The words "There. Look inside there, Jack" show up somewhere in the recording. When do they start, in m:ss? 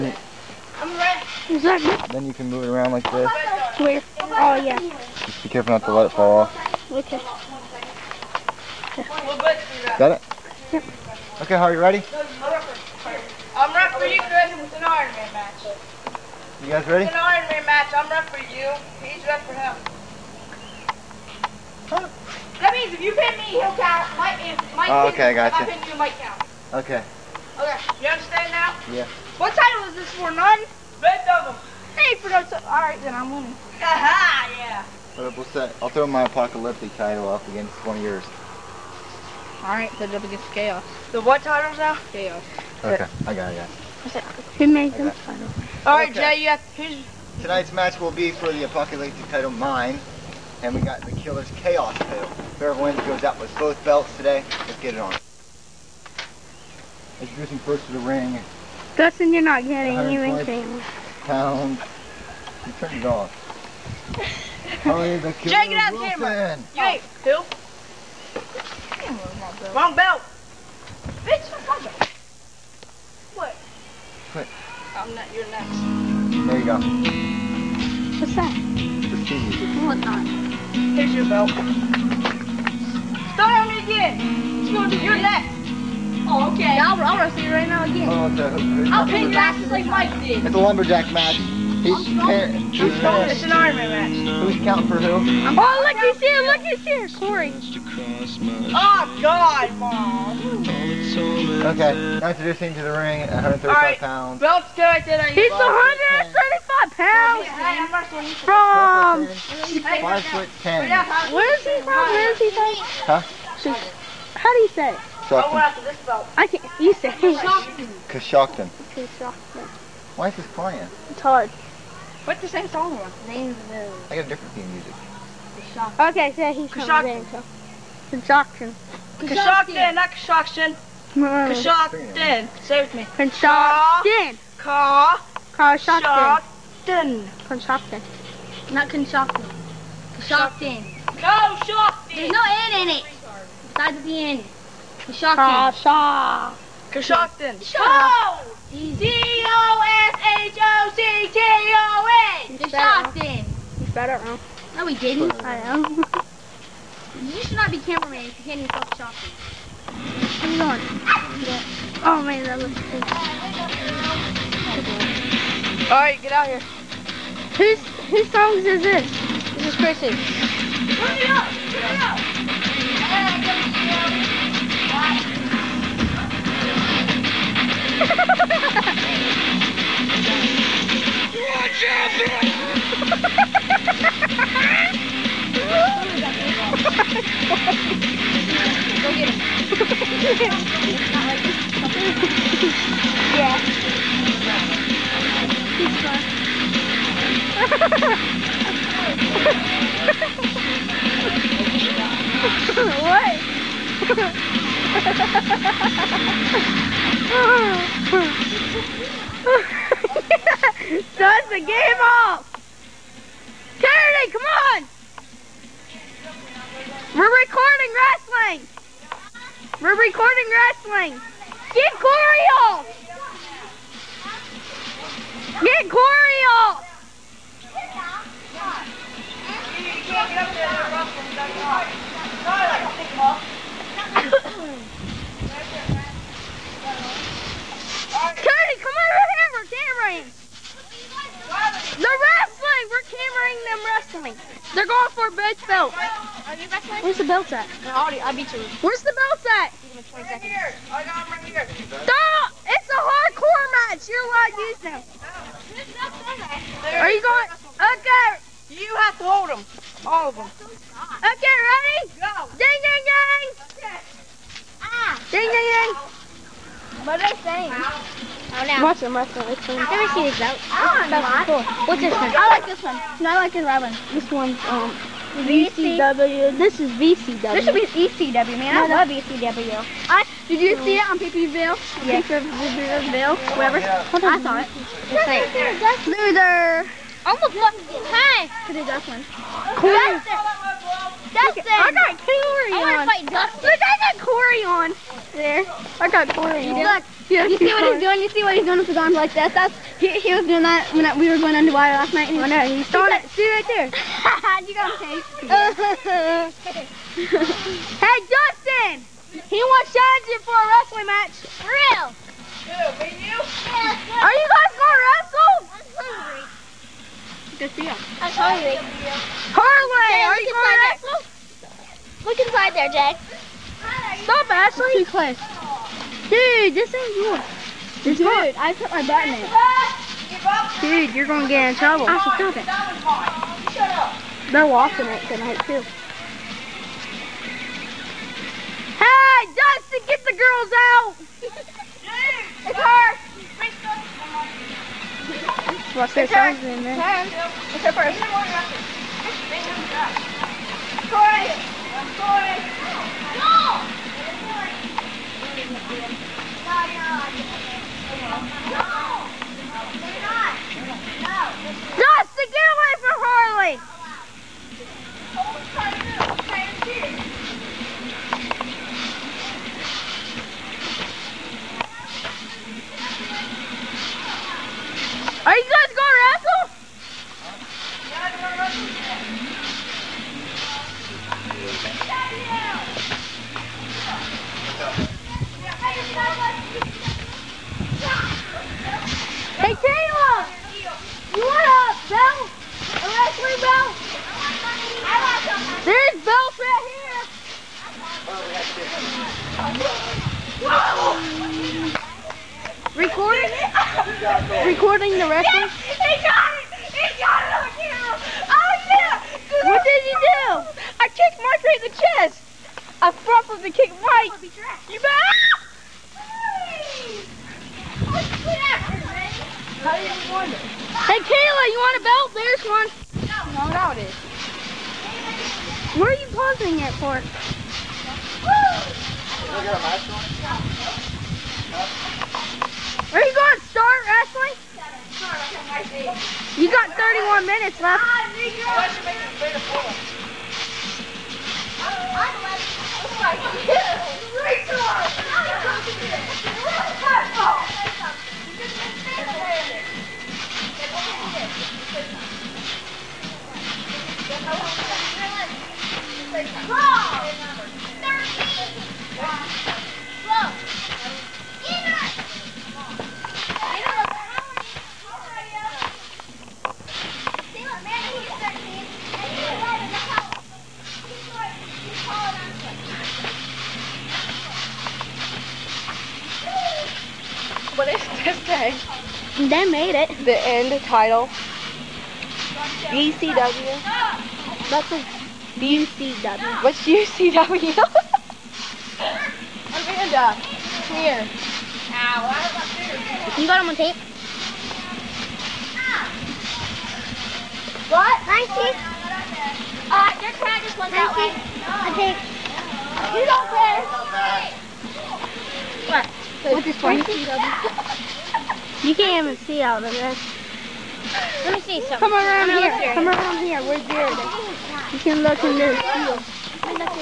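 5:21.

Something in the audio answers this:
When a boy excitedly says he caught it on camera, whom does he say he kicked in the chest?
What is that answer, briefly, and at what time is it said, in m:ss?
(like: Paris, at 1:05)
Mark, at 6:51.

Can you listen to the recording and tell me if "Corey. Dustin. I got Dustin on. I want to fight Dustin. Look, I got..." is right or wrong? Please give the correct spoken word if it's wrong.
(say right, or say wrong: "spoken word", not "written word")
wrong: "Corey", not "Dustin".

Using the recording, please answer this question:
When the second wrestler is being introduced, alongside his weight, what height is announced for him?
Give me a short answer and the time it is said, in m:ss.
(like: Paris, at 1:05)
5 foot 10, at 1:49.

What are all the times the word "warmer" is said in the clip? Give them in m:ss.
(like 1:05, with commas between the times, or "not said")
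not said.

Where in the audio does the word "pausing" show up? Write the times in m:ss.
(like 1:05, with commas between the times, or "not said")
7:06.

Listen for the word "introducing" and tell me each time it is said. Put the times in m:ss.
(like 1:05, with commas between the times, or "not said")
0:57, 1:42.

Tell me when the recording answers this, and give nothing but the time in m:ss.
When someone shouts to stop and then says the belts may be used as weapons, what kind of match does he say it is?
4:12.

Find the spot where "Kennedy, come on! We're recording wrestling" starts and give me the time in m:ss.
3:33.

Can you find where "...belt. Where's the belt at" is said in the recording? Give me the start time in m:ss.
4:05.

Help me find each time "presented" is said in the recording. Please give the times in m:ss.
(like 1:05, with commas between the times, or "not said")
not said.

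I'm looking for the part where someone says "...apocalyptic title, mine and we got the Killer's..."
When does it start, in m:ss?
0:48.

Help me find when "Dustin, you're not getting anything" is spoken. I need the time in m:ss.
0:58.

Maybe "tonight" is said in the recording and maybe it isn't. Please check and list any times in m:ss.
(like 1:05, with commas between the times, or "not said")
0:47, 5:35.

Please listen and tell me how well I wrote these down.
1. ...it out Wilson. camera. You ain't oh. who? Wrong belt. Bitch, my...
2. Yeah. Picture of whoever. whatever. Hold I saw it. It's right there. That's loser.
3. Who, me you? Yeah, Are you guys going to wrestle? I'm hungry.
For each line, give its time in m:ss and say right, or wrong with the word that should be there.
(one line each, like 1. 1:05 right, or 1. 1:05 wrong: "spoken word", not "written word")
1. 1:05 right
2. 4:42 right
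3. 5:12 right.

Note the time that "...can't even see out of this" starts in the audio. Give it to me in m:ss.
8:28.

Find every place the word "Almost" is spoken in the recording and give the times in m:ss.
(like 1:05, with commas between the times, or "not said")
4:47.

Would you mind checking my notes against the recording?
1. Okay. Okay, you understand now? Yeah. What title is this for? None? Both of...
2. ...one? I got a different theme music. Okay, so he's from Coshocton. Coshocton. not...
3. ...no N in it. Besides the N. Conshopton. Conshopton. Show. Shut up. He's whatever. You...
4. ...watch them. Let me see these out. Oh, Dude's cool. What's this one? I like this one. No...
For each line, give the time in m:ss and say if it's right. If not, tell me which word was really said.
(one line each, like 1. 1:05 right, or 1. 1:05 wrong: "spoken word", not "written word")
1. 0:26 right
2. 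2:02 right
3. 2:22 wrong: "better", not "whatever"
4. 4:29 wrong: "That", not "Dude".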